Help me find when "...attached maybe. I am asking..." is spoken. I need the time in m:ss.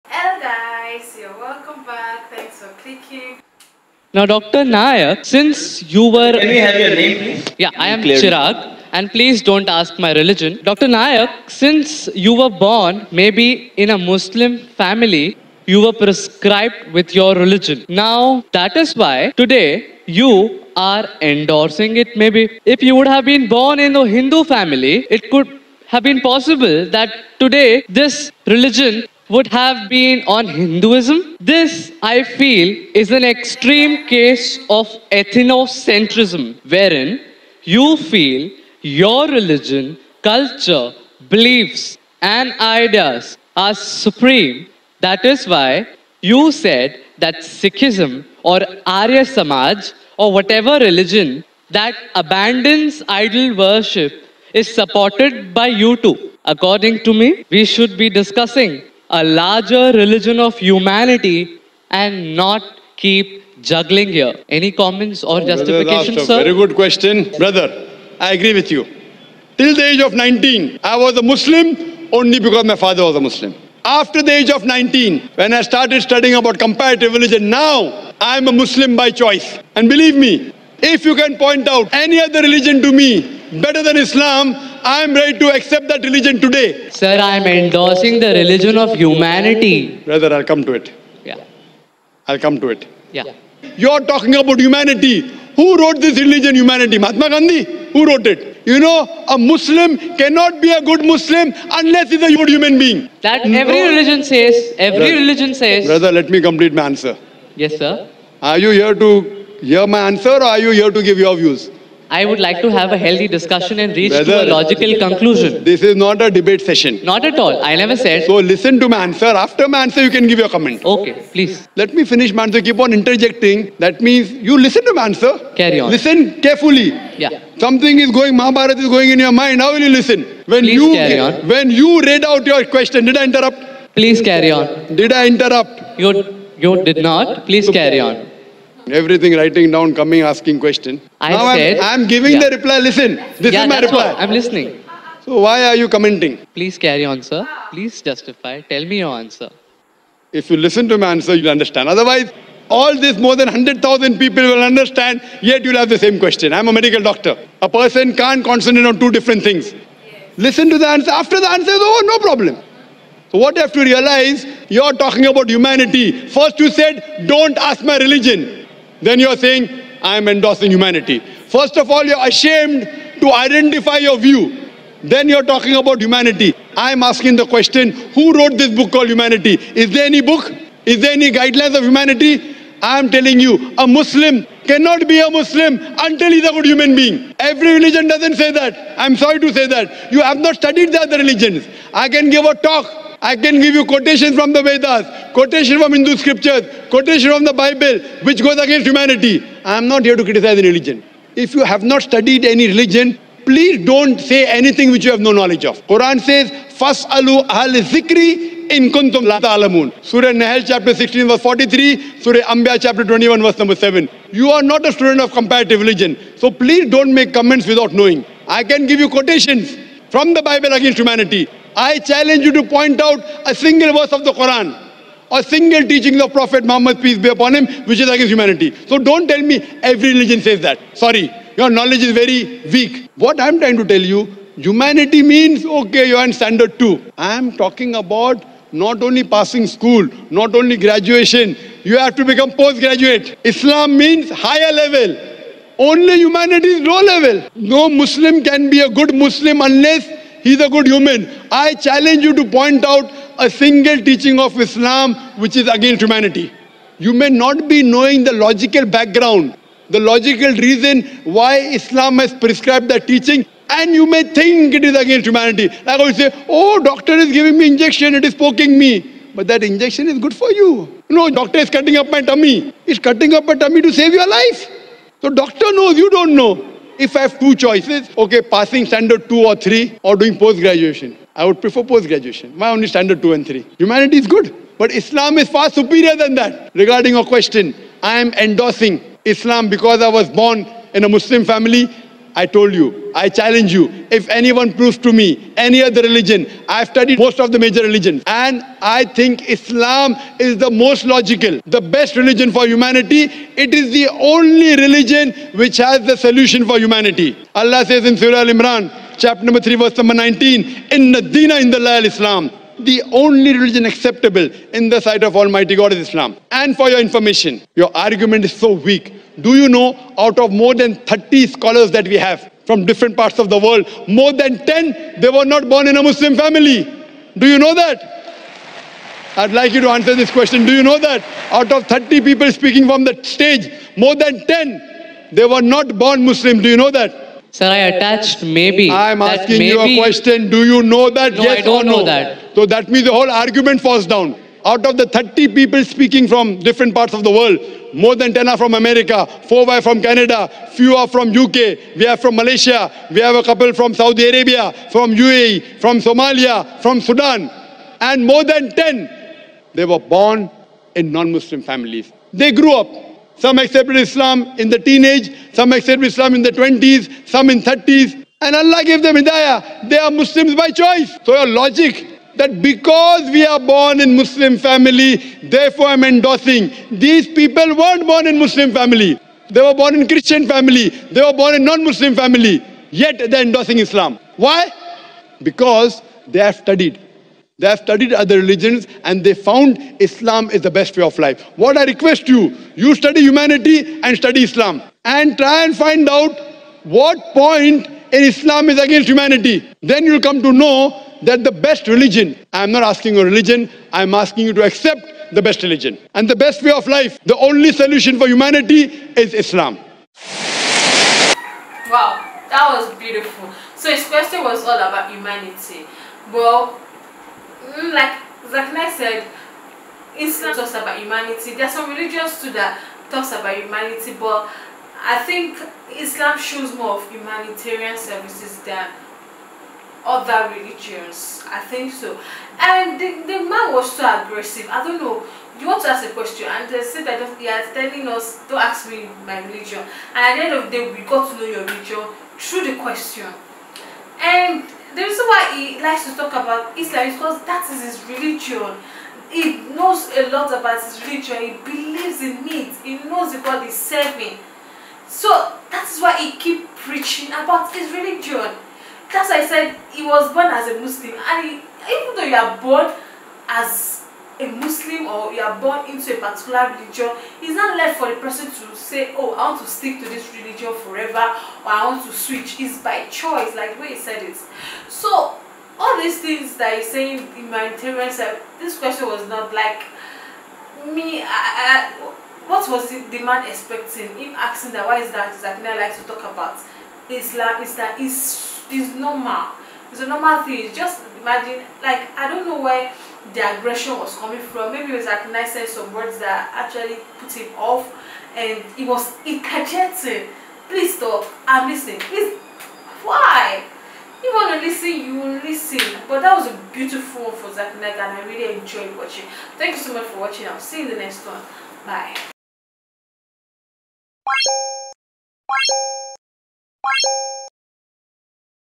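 5:37.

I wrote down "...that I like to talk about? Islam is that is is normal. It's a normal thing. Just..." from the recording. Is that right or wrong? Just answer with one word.
right.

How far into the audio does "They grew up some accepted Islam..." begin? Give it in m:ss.
6:02.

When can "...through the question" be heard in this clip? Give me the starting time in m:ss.
7:22.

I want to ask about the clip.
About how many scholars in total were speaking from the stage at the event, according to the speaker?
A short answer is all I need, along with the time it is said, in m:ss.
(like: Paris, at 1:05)
30, at 5:20.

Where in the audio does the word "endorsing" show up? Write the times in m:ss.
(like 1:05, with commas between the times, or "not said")
0:21, 1:27, 2:50, 4:48, 6:16, 6:23.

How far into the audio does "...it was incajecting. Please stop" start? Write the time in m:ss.
8:18.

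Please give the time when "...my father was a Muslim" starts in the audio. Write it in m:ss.
1:12.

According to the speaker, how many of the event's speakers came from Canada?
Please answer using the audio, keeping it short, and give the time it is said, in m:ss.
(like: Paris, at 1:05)
4, at 5:49.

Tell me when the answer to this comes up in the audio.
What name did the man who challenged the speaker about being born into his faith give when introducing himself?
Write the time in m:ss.
0:08.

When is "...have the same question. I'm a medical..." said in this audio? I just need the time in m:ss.
2:35.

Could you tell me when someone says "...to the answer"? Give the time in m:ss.
2:40.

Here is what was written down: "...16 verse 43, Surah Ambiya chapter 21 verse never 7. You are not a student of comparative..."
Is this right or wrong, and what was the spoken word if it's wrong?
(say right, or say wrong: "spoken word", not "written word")
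wrong: "number", not "never".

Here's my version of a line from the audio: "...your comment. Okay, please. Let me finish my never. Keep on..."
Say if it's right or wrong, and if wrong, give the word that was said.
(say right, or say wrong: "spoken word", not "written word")
wrong: "answer", not "never".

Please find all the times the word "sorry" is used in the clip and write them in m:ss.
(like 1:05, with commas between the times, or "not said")
3:09, 3:50.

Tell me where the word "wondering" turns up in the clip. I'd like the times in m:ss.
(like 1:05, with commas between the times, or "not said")
not said.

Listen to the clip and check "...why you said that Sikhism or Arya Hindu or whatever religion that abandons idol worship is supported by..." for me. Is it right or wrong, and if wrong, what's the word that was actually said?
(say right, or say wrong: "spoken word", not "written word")
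wrong: "Samaj", not "Hindu".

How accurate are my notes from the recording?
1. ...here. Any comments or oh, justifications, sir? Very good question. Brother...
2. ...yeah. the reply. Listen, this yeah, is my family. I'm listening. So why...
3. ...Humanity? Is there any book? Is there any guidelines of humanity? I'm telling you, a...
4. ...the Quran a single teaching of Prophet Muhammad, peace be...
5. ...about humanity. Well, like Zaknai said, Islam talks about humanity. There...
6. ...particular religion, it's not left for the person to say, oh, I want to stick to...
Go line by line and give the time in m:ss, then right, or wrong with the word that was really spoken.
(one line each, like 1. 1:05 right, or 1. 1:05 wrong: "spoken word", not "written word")
1. 1:04 right
2. 2:22 wrong: "reply", not "family"
3. 2:59 right
4. 3:44 right
5. 6:54 right
6. 7:46 right.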